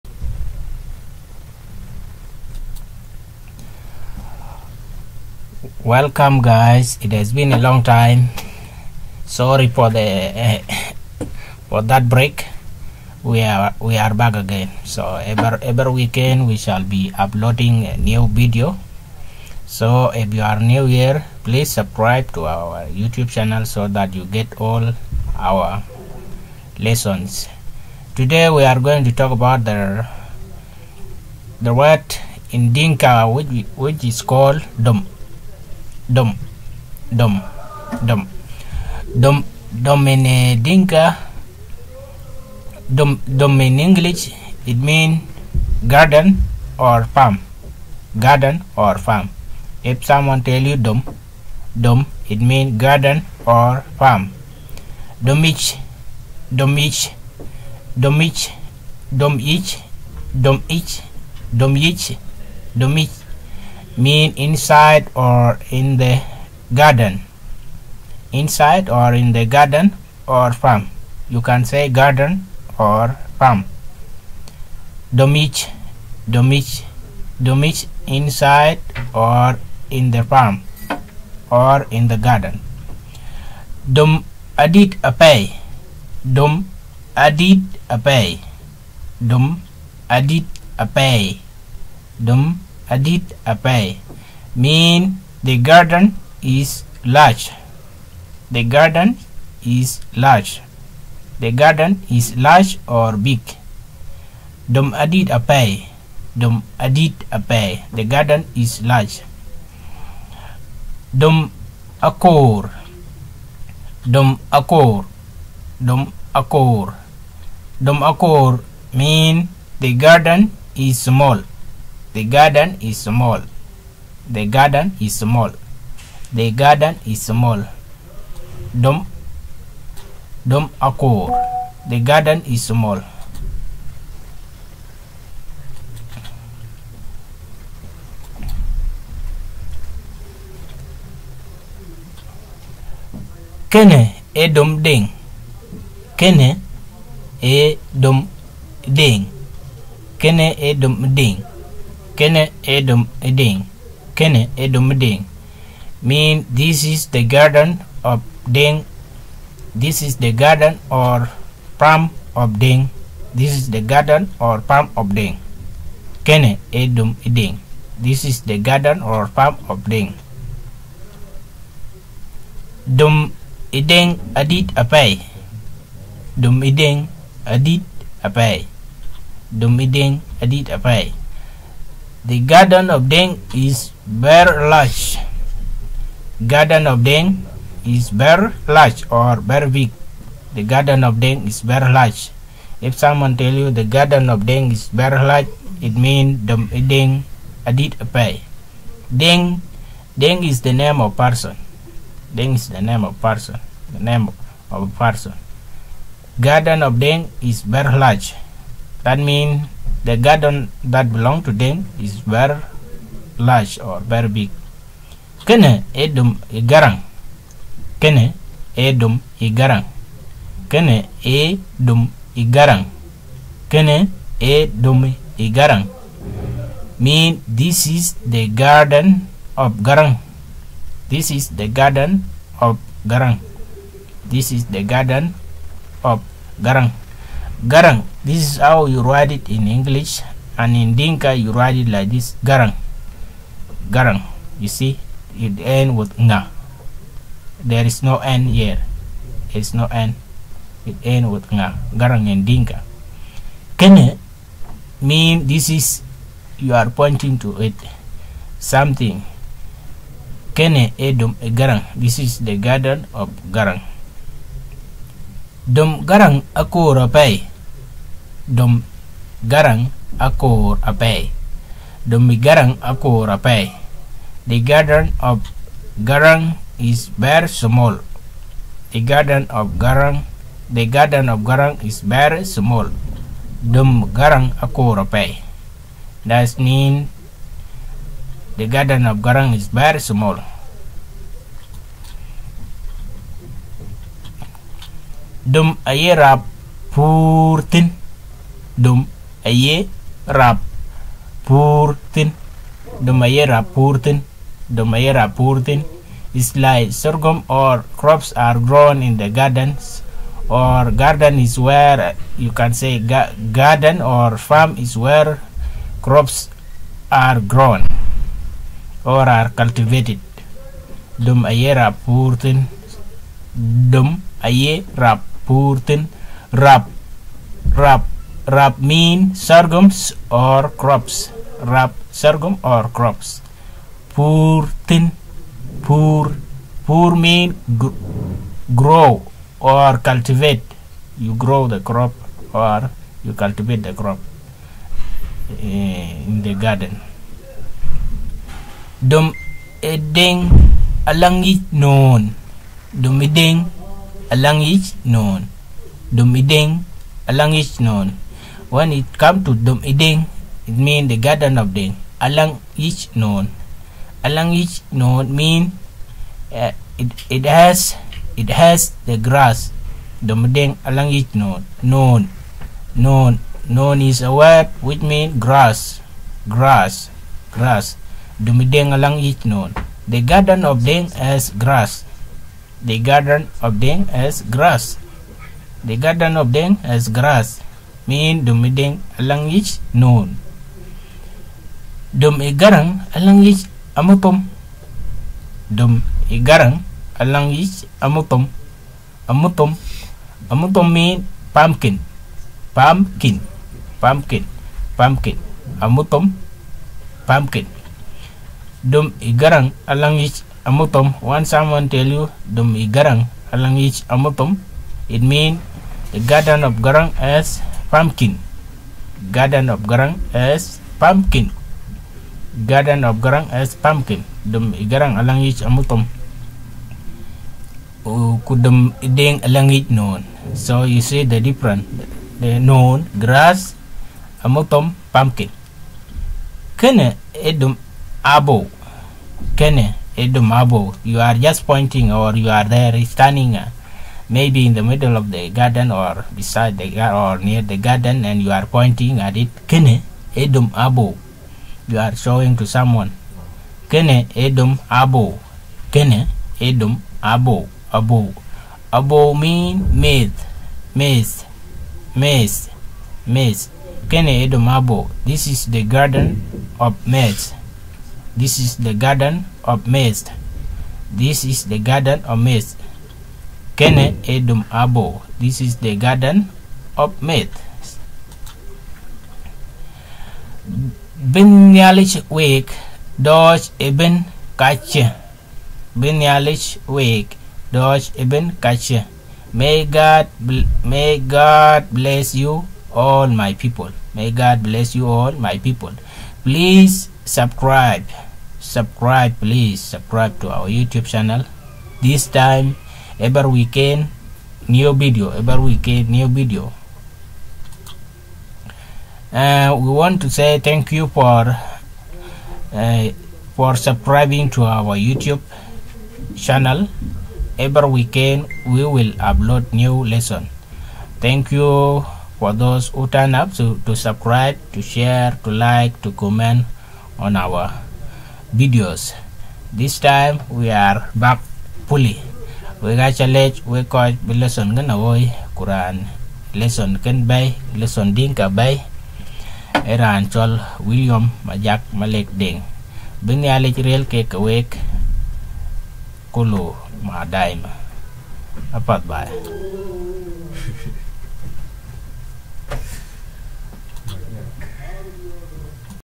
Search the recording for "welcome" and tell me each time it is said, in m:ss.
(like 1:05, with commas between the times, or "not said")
0:05.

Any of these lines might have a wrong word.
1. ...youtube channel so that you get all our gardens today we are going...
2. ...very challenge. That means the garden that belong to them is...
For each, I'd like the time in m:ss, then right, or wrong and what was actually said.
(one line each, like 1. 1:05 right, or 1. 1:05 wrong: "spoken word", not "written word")
1. 0:22 wrong: "lessons", not "gardens"
2. 3:27 wrong: "large", not "challenge".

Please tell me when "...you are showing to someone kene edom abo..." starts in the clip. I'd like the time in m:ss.
7:31.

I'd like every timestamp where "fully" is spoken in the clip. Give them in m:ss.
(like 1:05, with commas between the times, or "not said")
8:51.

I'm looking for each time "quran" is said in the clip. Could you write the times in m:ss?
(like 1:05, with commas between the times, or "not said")
8:55.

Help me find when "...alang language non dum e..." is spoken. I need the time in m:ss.
6:28.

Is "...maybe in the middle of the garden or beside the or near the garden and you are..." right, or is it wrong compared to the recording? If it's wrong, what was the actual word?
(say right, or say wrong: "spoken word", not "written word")
right.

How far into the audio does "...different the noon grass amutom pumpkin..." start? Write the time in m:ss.
7:11.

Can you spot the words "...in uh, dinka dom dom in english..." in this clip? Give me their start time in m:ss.
0:40.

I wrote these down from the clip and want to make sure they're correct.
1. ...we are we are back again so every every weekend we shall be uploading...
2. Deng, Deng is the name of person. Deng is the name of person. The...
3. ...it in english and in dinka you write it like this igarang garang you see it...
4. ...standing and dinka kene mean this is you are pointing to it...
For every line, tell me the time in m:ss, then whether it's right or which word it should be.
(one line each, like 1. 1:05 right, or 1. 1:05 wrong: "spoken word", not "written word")
1. 0:13 right
2. 3:19 right
3. 3:59 wrong: "garang", not "igarang"
4. 4:11 wrong: "garang", not "standing".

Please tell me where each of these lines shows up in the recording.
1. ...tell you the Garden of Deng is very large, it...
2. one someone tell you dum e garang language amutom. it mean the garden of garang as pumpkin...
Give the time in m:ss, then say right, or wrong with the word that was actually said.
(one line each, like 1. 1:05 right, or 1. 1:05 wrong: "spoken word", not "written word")
1. 3:13 right
2. 6:51 right.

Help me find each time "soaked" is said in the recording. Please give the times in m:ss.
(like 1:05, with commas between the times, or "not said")
not said.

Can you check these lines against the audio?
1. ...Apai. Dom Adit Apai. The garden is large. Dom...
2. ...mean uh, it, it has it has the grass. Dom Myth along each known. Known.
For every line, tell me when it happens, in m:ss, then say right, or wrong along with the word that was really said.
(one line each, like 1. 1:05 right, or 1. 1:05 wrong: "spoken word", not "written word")
1. 1:45 right
2. 6:05 wrong: "Eden", not "Myth".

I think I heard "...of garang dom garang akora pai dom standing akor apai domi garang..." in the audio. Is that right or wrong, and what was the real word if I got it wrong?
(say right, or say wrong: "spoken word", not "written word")
wrong: "garang", not "standing".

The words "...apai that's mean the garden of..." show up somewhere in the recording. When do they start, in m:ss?
4:44.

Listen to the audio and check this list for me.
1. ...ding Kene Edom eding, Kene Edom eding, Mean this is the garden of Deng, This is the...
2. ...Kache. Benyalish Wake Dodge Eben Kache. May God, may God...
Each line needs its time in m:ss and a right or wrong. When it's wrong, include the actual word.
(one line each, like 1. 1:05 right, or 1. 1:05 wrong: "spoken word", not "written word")
1. 2:31 right
2. 8:04 right.